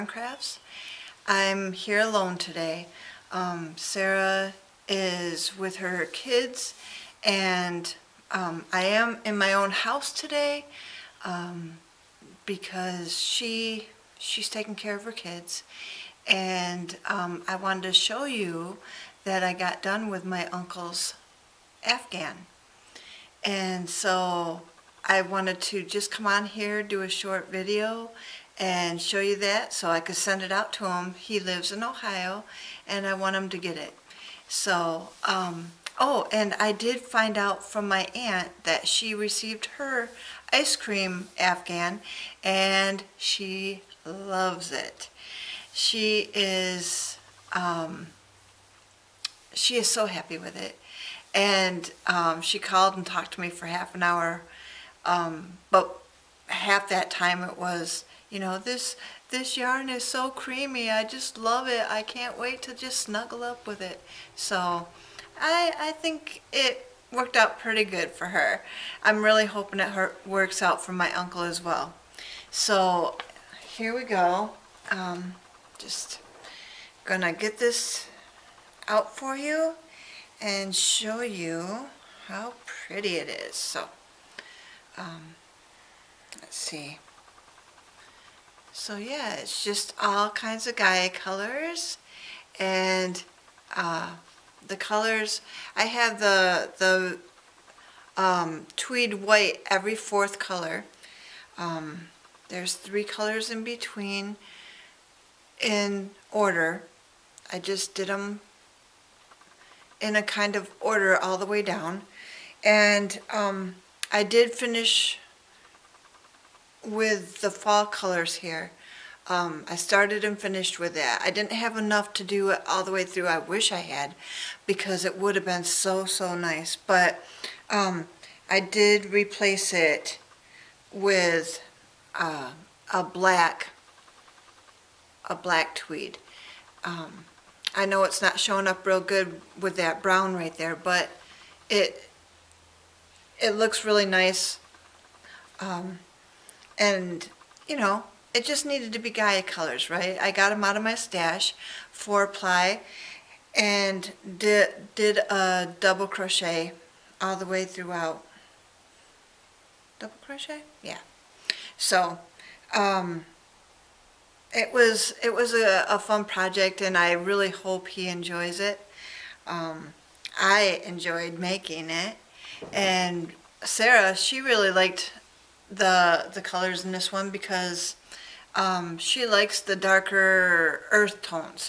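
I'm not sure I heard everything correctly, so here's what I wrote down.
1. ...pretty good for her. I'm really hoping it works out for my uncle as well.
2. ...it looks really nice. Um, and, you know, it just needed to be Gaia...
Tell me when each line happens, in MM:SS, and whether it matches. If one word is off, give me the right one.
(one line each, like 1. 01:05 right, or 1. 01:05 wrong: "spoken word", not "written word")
1. 01:07 right
2. 02:23 right.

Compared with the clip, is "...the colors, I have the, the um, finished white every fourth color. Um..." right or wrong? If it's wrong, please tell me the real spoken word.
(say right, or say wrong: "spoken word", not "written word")
wrong: "tweed", not "finished".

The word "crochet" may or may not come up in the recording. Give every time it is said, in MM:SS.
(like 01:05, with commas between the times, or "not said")
02:36, 02:40.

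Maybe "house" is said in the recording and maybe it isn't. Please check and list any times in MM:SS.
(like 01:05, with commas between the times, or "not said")
00:09.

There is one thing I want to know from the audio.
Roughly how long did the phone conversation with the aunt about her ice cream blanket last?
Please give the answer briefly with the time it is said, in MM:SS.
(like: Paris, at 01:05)
half an hour, at 00:53.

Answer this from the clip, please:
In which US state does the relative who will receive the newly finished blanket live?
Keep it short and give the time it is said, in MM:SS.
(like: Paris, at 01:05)
Ohio, at 00:31.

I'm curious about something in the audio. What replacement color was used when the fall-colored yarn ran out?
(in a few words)
black tweed.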